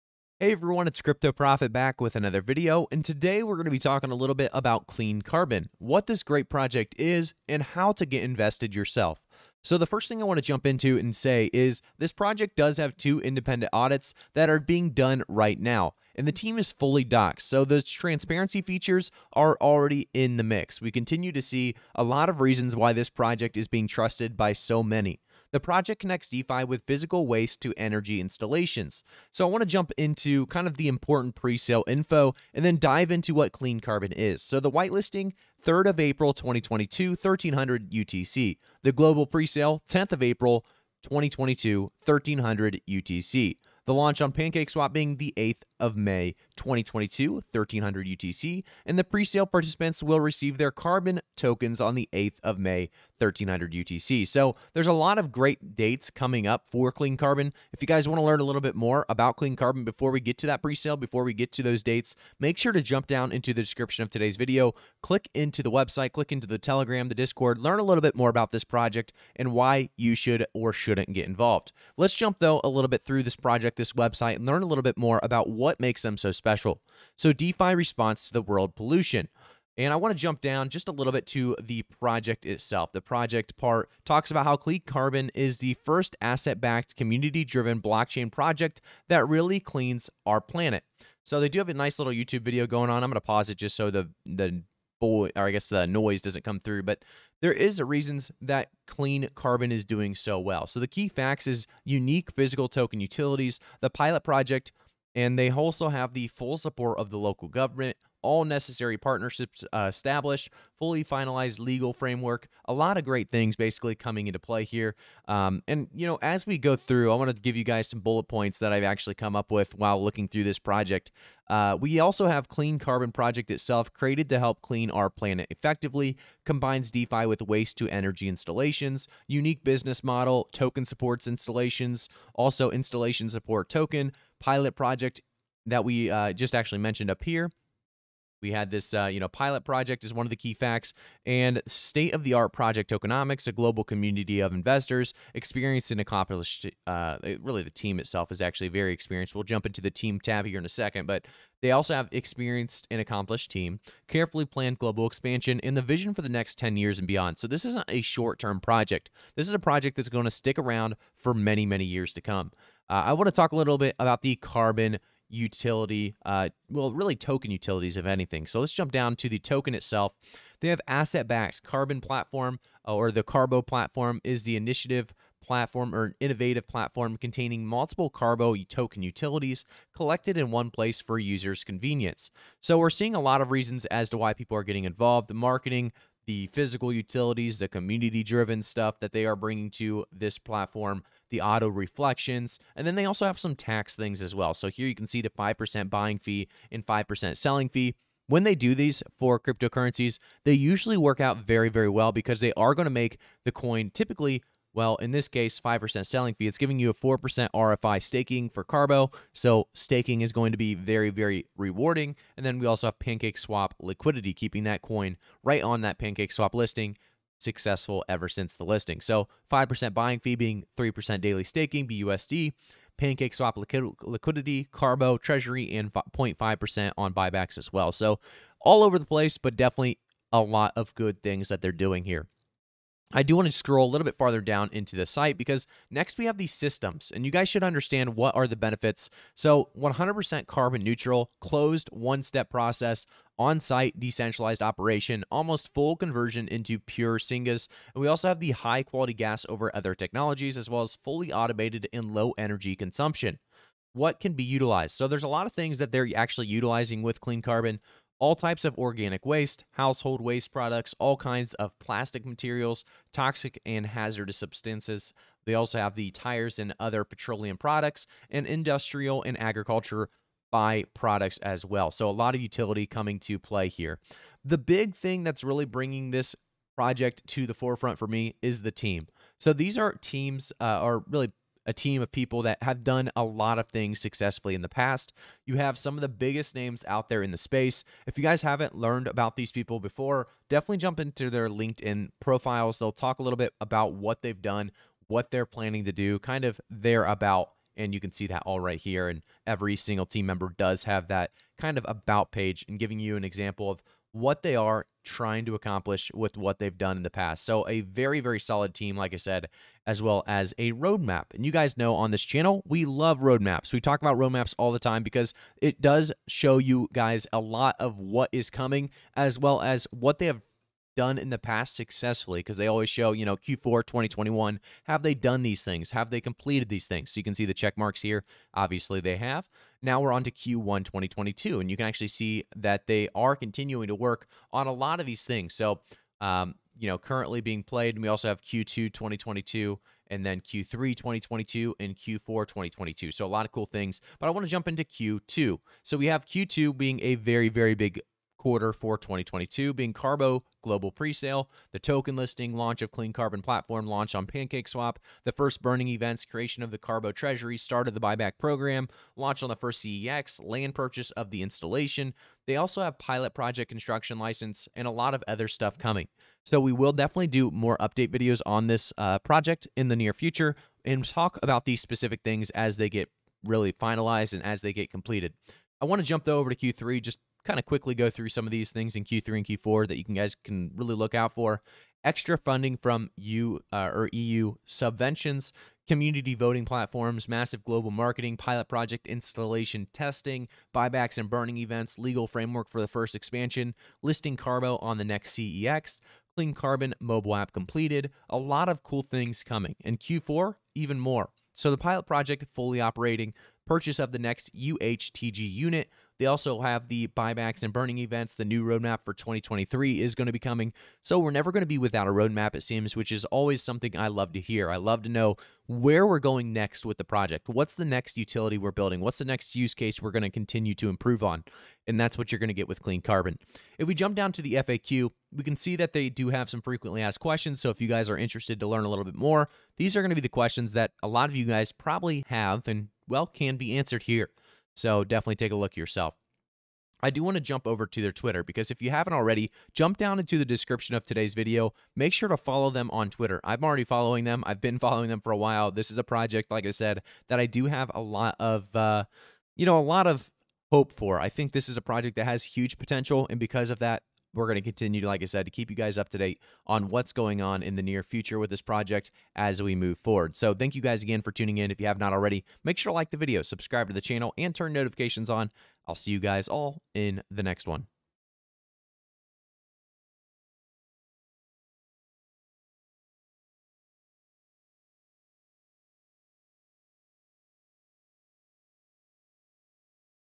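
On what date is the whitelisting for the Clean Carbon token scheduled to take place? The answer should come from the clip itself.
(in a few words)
3 April 2022.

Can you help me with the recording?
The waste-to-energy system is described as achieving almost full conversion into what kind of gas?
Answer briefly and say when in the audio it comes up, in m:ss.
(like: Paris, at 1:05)
Pure syngas, at 4:06.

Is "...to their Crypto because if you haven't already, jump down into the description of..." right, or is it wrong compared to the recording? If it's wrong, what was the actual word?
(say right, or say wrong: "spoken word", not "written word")
wrong: "Twitter", not "Crypto".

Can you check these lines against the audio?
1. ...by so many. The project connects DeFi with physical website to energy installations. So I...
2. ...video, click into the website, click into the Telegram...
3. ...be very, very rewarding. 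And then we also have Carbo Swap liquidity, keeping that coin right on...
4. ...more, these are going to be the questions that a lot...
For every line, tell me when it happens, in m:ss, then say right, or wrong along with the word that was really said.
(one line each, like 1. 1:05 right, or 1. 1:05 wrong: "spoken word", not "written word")
1. 0:24 wrong: "waste", not "website"
2. 1:04 right
3. 3:30 wrong: "Pancake", not "Carbo"
4. 7:09 right.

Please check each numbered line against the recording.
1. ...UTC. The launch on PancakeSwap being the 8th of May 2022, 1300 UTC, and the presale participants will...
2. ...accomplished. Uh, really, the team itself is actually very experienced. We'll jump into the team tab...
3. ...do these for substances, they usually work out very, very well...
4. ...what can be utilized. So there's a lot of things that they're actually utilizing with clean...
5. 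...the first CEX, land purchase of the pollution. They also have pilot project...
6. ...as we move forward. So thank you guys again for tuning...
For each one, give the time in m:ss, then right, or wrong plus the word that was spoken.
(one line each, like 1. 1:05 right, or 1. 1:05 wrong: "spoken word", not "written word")
1. 0:42 right
2. 2:26 right
3. 3:18 wrong: "cryptocurrencies", not "substances"
4. 4:13 right
5. 5:59 wrong: "installation", not "pollution"
6. 7:39 right.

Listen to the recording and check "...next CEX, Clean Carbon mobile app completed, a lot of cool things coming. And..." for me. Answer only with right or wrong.
right.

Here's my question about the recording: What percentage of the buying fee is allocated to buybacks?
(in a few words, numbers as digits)
0.5%.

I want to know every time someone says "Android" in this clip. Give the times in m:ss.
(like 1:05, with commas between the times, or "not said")
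not said.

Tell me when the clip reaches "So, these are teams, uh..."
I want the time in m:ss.
4:39.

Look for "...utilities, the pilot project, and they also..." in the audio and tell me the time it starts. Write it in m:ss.
1:42.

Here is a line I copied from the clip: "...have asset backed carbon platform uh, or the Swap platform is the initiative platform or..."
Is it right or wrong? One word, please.
wrong.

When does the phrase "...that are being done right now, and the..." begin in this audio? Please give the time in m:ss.
0:14.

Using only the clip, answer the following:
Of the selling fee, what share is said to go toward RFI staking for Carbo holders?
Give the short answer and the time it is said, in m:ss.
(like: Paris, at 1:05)
4%, at 3:26.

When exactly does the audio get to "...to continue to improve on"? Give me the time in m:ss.
7:00.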